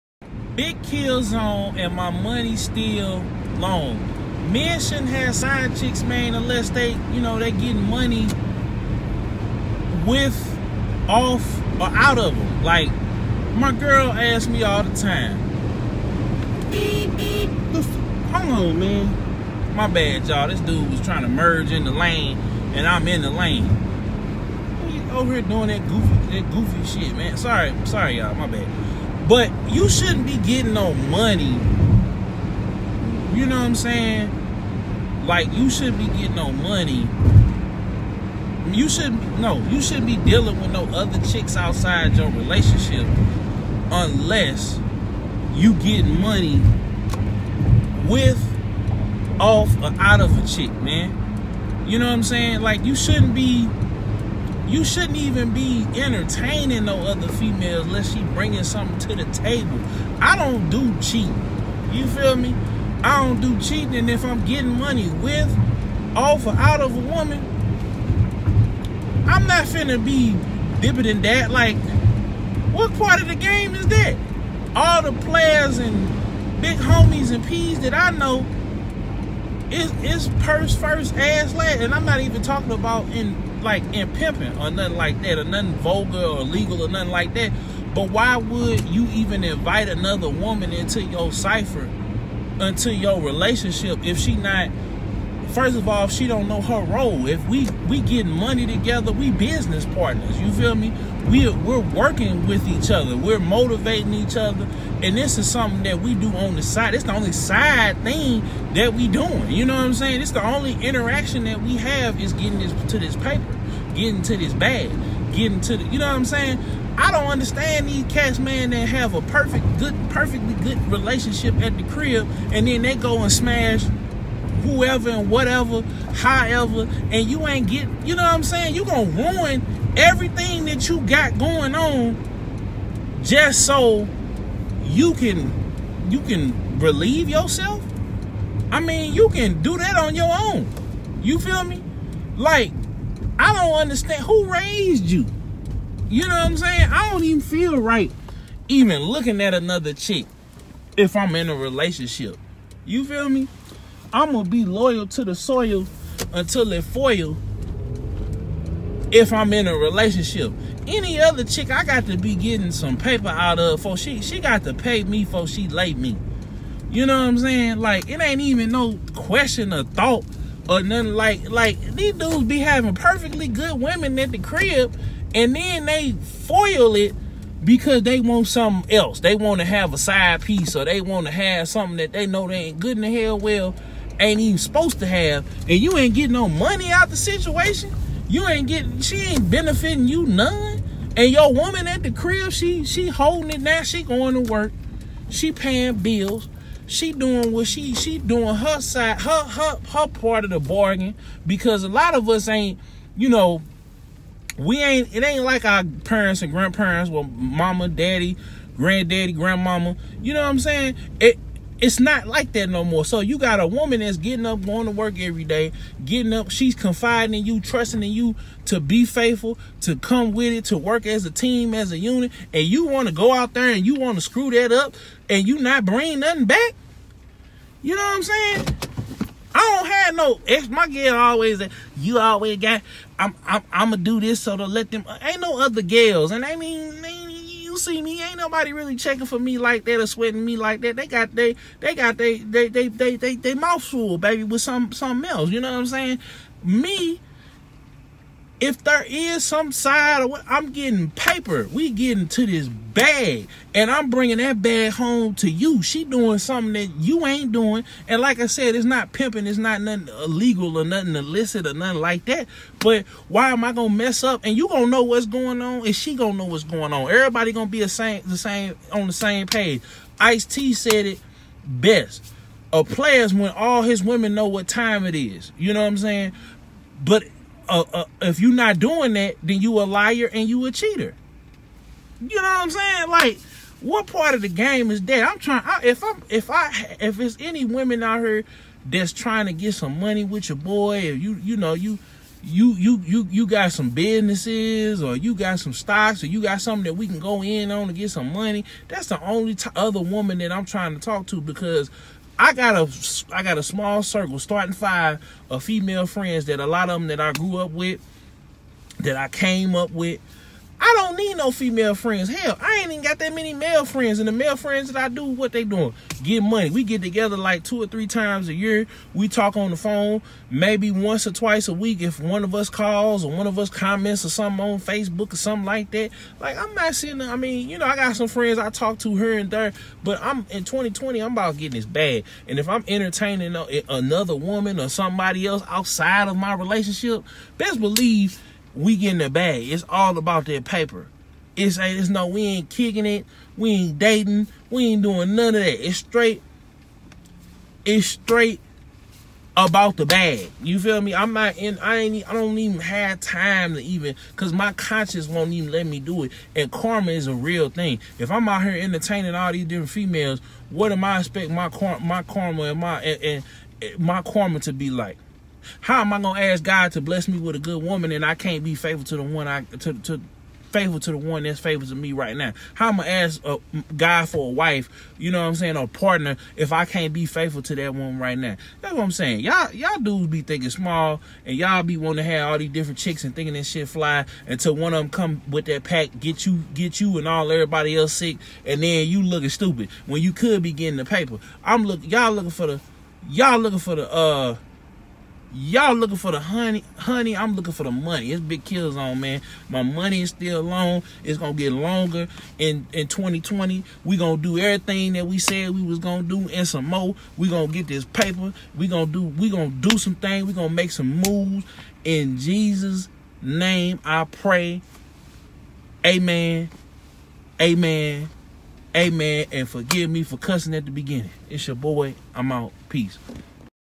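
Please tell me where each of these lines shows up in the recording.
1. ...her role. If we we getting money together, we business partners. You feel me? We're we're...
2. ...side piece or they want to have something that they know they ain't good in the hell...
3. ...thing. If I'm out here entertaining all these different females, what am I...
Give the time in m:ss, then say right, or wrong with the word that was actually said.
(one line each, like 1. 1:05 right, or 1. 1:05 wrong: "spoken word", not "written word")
1. 1:36 right
2. 2:59 right
3. 5:57 right.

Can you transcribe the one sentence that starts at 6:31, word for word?
I'm look y'all looking for the y'all looking for the uh Y'all looking for the honey, honey.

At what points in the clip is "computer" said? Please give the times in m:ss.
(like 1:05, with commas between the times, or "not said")
not said.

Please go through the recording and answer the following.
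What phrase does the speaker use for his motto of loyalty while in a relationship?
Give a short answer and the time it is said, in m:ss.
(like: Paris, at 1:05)
loyal to the soil, at 2:34.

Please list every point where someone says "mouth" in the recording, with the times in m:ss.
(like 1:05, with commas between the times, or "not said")
4:03.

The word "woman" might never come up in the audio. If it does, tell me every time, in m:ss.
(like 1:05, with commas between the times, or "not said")
1:06, 1:30, 3:11, 3:33, 5:00, 5:34, 6:07, 6:17.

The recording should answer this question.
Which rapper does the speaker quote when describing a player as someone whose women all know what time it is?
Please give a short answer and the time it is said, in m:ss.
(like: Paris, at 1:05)
Ice T, at 4:30.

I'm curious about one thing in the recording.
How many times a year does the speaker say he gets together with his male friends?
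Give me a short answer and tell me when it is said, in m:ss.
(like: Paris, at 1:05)
two or three times, at 5:17.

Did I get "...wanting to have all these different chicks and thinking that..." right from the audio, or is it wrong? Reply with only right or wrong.
right.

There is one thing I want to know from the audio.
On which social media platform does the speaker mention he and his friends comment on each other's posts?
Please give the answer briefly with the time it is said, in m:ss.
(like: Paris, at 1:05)
Facebook, at 5:24.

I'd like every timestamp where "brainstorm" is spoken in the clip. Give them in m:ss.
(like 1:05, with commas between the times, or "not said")
not said.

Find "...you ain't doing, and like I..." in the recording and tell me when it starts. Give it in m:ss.
4:16.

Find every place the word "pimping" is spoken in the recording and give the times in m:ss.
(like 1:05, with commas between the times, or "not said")
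1:24, 4:19.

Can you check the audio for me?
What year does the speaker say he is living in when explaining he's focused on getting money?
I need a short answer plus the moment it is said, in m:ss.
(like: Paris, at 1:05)
2020, at 5:30.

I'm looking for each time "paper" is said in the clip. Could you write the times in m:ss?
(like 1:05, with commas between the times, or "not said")
1:53, 2:42, 4:11, 5:40, 6:31, 6:48.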